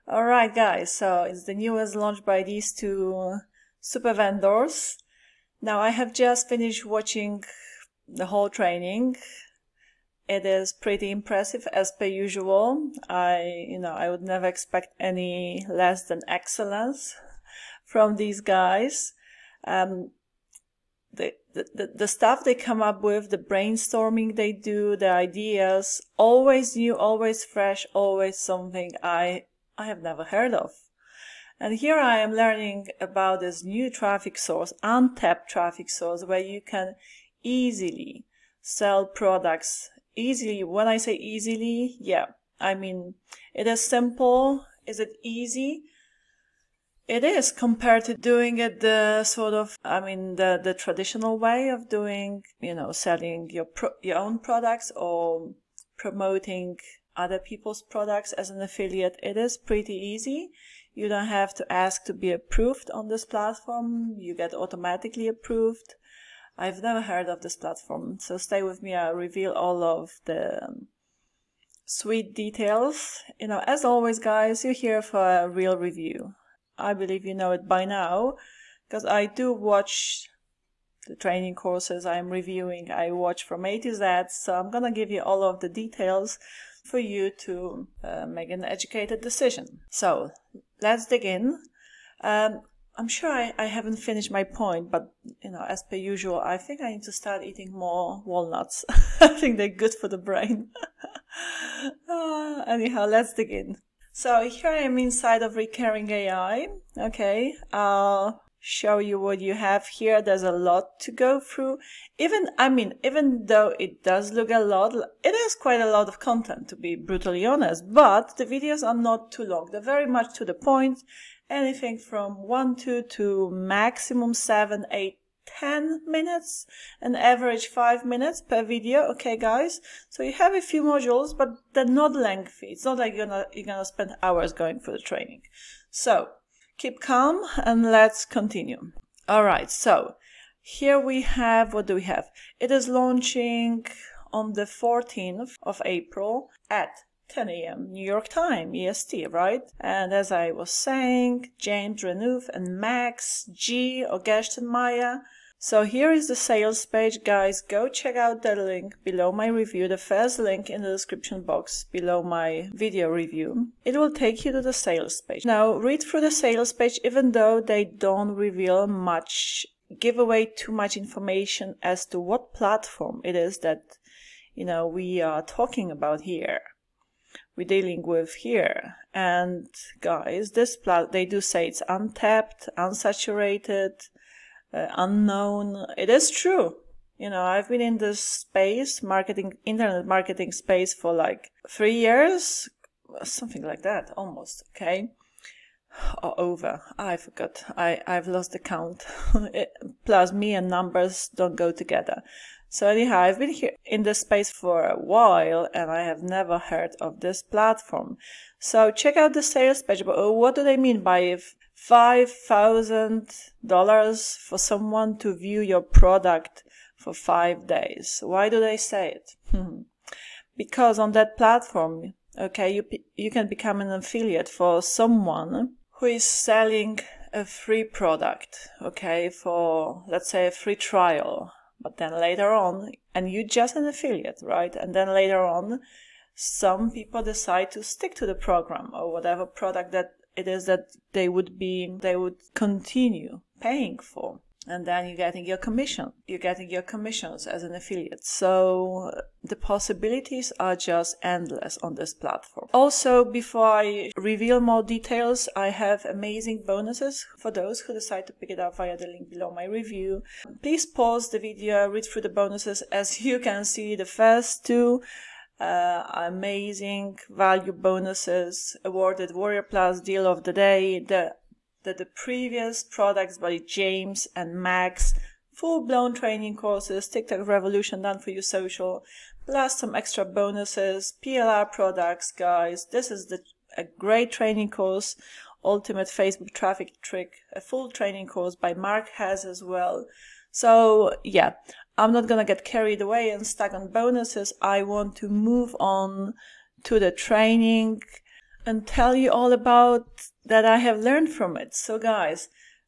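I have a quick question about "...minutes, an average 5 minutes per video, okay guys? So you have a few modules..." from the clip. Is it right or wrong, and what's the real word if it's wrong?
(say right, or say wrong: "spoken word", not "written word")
right.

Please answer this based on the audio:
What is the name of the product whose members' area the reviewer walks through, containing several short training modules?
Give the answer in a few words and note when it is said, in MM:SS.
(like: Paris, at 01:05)
Recurring AI, at 01:45.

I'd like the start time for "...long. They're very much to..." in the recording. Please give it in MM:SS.
01:59.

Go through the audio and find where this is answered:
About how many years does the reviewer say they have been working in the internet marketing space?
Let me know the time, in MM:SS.
03:11.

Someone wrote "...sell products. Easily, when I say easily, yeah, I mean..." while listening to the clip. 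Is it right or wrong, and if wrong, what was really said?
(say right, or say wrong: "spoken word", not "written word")
right.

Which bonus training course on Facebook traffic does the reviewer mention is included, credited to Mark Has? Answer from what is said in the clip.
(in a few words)
Ultimate Facebook Traffic Trick.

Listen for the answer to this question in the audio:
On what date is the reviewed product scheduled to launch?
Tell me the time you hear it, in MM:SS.
02:24.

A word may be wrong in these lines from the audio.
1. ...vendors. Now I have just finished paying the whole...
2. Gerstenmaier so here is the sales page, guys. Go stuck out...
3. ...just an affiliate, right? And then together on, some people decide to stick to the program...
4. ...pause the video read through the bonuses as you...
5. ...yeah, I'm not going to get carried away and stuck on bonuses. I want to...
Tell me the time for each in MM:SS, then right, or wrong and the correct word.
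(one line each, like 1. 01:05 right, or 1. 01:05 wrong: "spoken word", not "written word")
1. 00:04 wrong: "watching", not "paying"
2. 02:34 wrong: "check", not "stuck"
3. 03:53 wrong: "later", not "together"
4. 04:20 right
5. 04:51 right.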